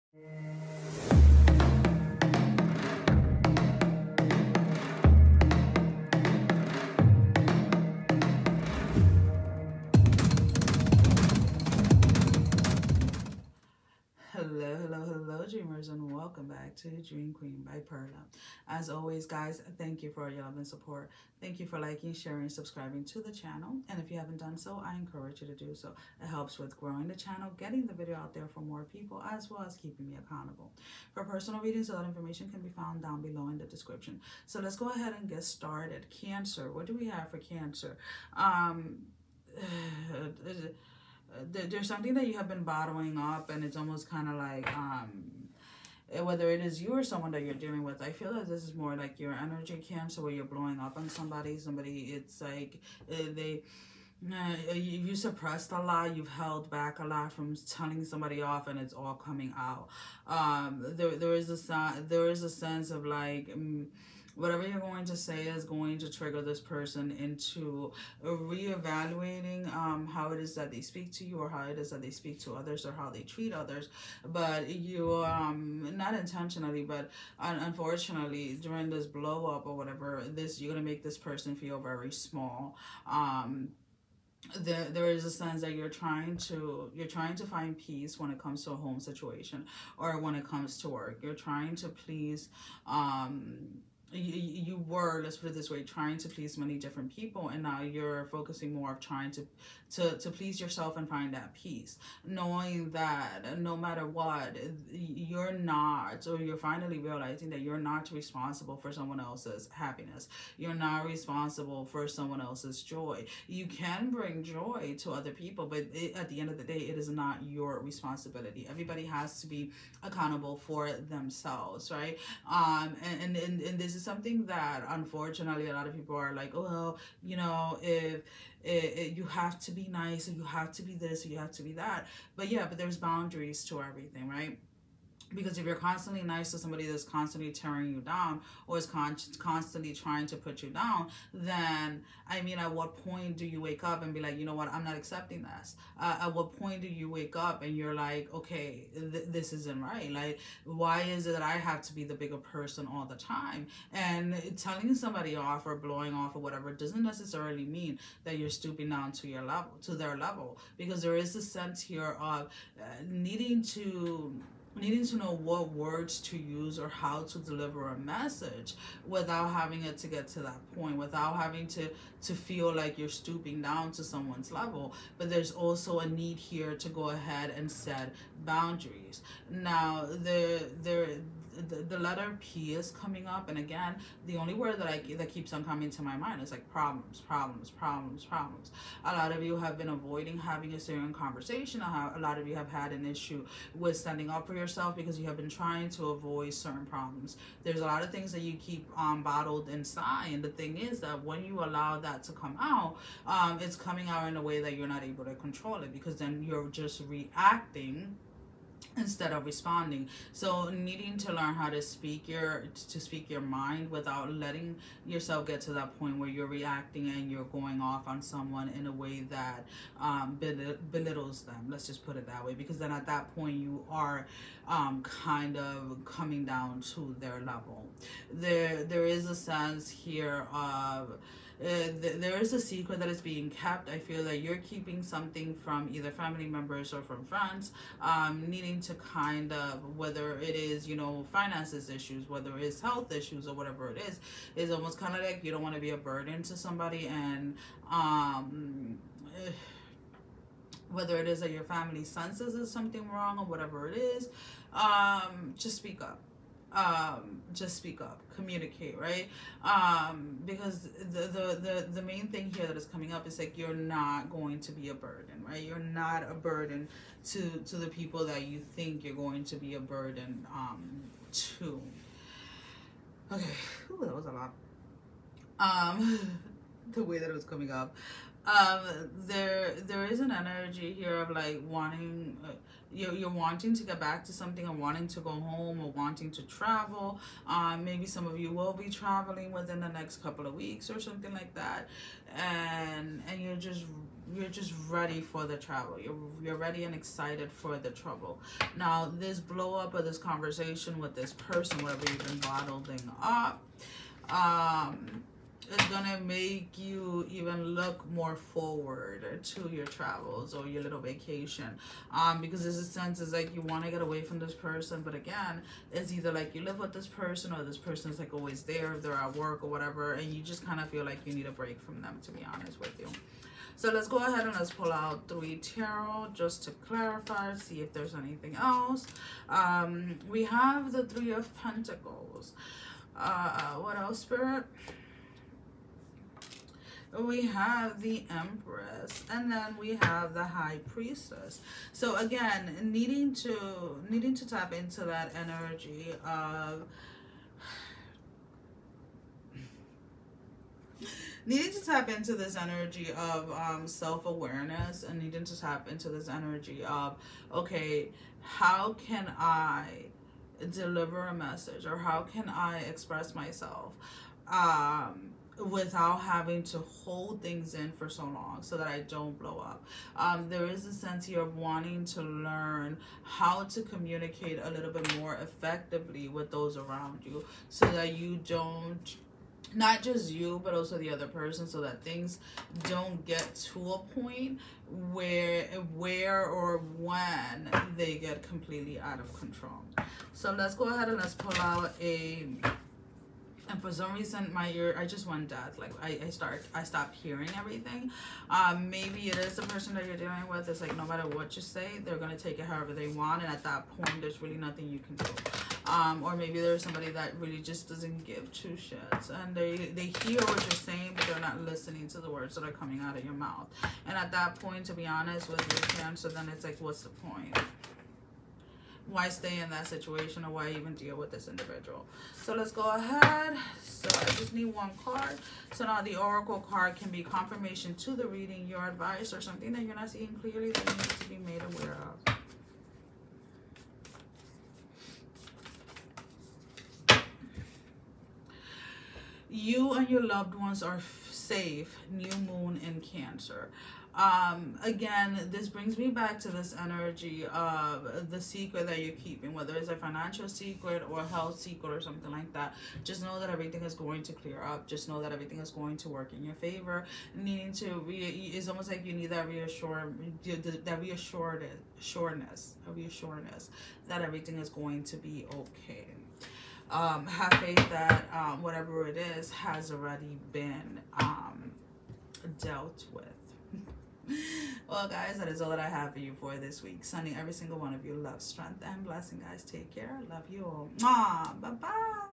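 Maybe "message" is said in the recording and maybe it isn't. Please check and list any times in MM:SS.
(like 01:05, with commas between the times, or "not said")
02:47, 06:01.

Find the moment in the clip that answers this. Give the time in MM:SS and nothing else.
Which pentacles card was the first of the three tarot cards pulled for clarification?
05:31.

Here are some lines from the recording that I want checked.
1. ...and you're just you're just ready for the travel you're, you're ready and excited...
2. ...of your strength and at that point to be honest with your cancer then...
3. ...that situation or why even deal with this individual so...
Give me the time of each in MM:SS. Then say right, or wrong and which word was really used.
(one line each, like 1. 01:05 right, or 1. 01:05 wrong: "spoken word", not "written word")
1. 04:53 right
2. 06:53 wrong: "mouth", not "strength"
3. 06:59 right.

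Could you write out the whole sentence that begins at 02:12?
But yeah, but there's boundaries to everything, right?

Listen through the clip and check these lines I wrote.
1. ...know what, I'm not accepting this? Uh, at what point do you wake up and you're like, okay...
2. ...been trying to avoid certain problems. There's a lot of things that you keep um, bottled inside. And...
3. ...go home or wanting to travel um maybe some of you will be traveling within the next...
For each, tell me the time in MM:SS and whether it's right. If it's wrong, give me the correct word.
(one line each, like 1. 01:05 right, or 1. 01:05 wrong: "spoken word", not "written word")
1. 02:24 right
2. 03:15 right
3. 04:45 right.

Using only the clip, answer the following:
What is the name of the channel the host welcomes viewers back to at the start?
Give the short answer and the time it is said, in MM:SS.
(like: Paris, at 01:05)
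Dream Queen, at 00:17.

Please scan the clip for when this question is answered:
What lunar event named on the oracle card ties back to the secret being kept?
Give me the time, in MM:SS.
07:22.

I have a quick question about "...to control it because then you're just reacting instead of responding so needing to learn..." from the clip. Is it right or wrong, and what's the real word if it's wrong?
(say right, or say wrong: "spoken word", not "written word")
right.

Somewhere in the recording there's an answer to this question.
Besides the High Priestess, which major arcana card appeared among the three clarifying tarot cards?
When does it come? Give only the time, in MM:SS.
05:38.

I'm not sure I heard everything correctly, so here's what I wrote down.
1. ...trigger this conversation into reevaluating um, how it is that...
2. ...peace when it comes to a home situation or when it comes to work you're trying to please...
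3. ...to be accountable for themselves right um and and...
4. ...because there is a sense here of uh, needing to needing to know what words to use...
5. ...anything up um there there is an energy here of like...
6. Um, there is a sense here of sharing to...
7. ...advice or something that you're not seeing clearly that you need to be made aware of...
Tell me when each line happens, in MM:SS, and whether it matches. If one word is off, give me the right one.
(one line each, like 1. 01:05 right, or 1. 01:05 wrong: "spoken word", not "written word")
1. 01:06 wrong: "person", not "conversation"
2. 01:27 right
3. 01:59 right
4. 02:40 right
5. 04:37 wrong: "coming", not "anything"
6. 06:10 wrong: "wanting", not "sharing"
7. 07:08 right.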